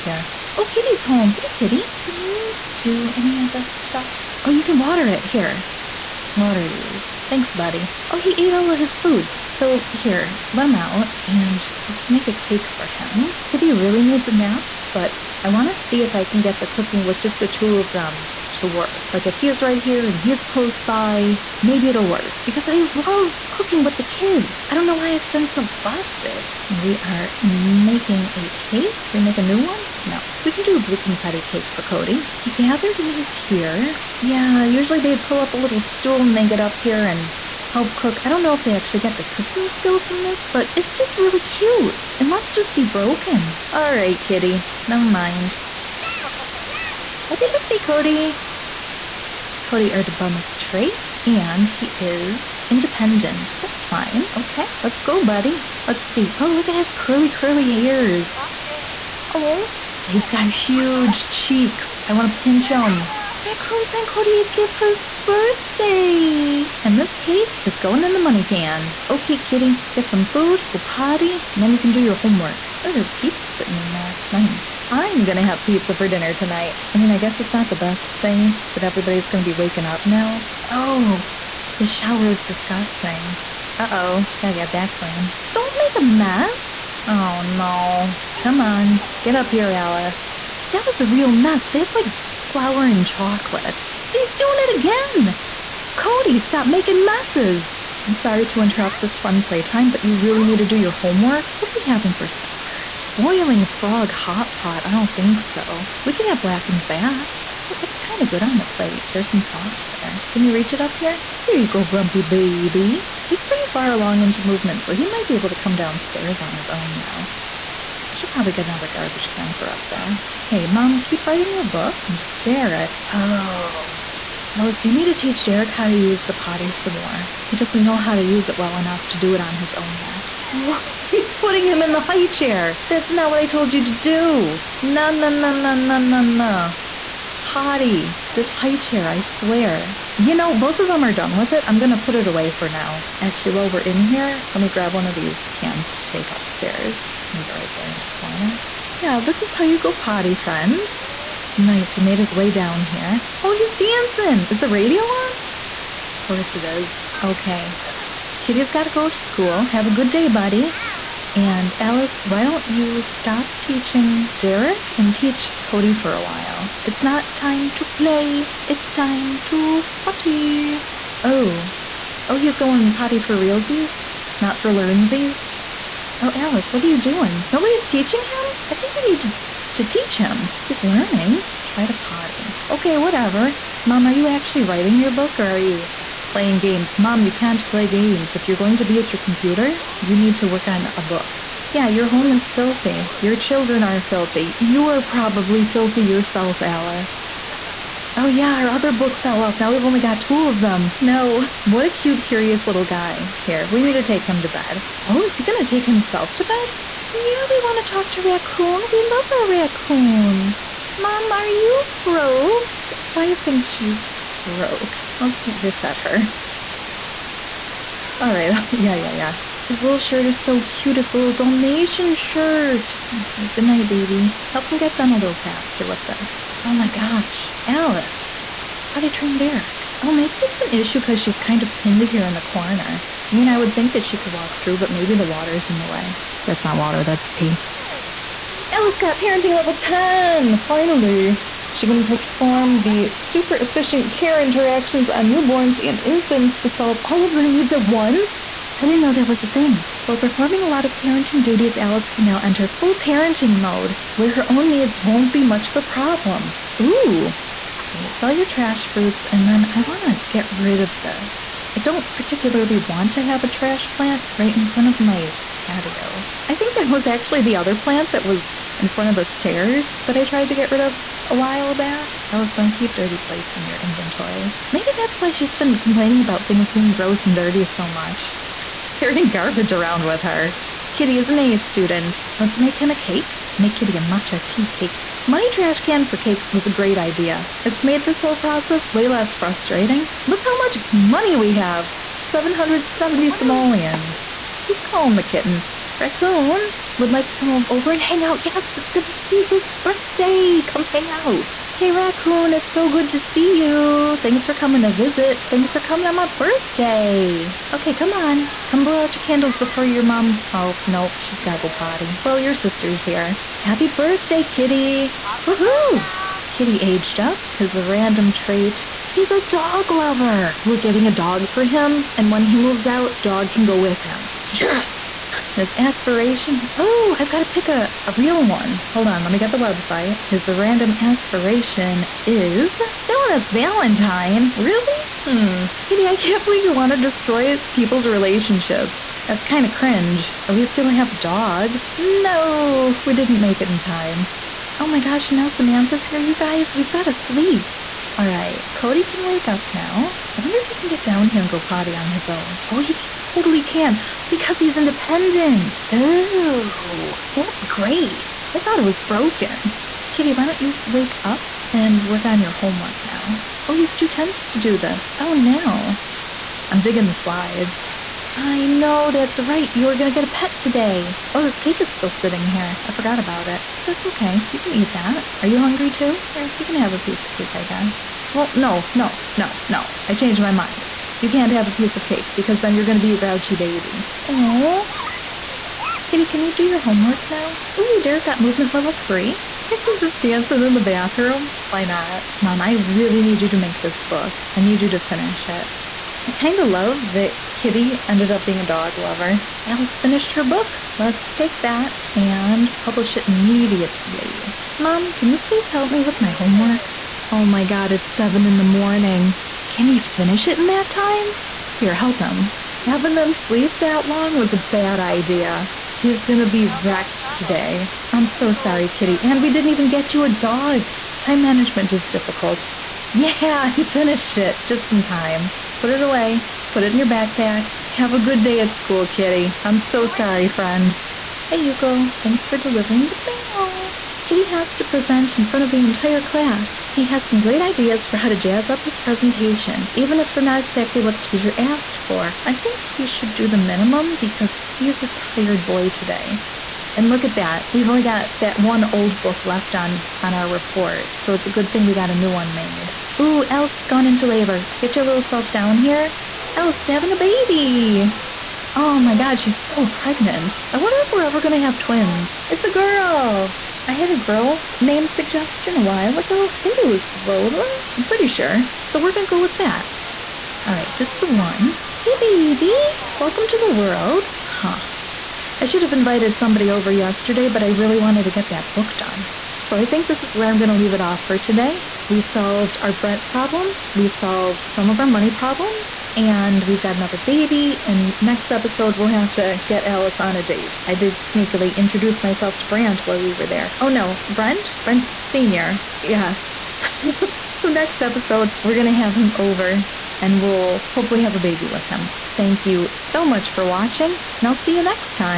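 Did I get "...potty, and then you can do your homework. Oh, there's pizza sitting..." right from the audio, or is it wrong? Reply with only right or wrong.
right.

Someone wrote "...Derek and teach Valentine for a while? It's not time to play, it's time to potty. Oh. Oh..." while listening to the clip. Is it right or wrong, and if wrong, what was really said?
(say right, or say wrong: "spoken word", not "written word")
wrong: "Cody", not "Valentine".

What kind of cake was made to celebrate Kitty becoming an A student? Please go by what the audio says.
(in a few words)
Matcha tea cake.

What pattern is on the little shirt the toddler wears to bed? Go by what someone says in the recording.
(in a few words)
Dalmatian.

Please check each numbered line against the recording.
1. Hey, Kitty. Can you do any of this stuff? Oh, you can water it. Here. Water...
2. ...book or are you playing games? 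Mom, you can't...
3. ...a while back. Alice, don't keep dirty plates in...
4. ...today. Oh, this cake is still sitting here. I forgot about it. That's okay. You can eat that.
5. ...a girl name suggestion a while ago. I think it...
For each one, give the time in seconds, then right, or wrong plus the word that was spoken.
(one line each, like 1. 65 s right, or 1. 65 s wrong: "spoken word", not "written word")
1. 1 s right
2. 185 s right
3. 271 s right
4. 370 s right
5. 464 s right.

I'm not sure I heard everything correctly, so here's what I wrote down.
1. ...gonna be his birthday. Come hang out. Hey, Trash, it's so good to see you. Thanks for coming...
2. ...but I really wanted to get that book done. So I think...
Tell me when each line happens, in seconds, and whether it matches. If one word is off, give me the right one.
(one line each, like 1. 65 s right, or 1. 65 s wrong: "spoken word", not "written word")
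1. 298 s wrong: "Raccoon", not "Trash"
2. 477 s right.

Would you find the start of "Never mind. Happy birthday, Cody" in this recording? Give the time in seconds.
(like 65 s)
44 s.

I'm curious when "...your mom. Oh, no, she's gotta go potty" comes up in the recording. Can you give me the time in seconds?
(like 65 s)
309 s.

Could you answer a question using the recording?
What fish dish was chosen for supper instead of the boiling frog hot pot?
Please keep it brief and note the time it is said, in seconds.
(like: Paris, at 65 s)
Blackened bass, at 106 s.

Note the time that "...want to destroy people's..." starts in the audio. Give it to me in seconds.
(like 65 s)
336 s.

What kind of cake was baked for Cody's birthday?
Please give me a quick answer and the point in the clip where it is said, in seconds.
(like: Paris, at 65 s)
Blue confetti cake, at 30 s.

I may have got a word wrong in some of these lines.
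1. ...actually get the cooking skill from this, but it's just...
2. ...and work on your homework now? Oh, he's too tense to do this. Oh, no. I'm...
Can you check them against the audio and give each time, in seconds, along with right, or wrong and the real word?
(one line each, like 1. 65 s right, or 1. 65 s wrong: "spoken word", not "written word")
1. 38 s right
2. 361 s right.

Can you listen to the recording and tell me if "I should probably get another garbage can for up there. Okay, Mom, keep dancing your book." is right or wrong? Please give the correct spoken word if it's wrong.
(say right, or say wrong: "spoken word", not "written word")
wrong: "writing", not "dancing".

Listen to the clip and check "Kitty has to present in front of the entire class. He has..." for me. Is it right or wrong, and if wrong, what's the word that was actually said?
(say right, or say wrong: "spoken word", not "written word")
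right.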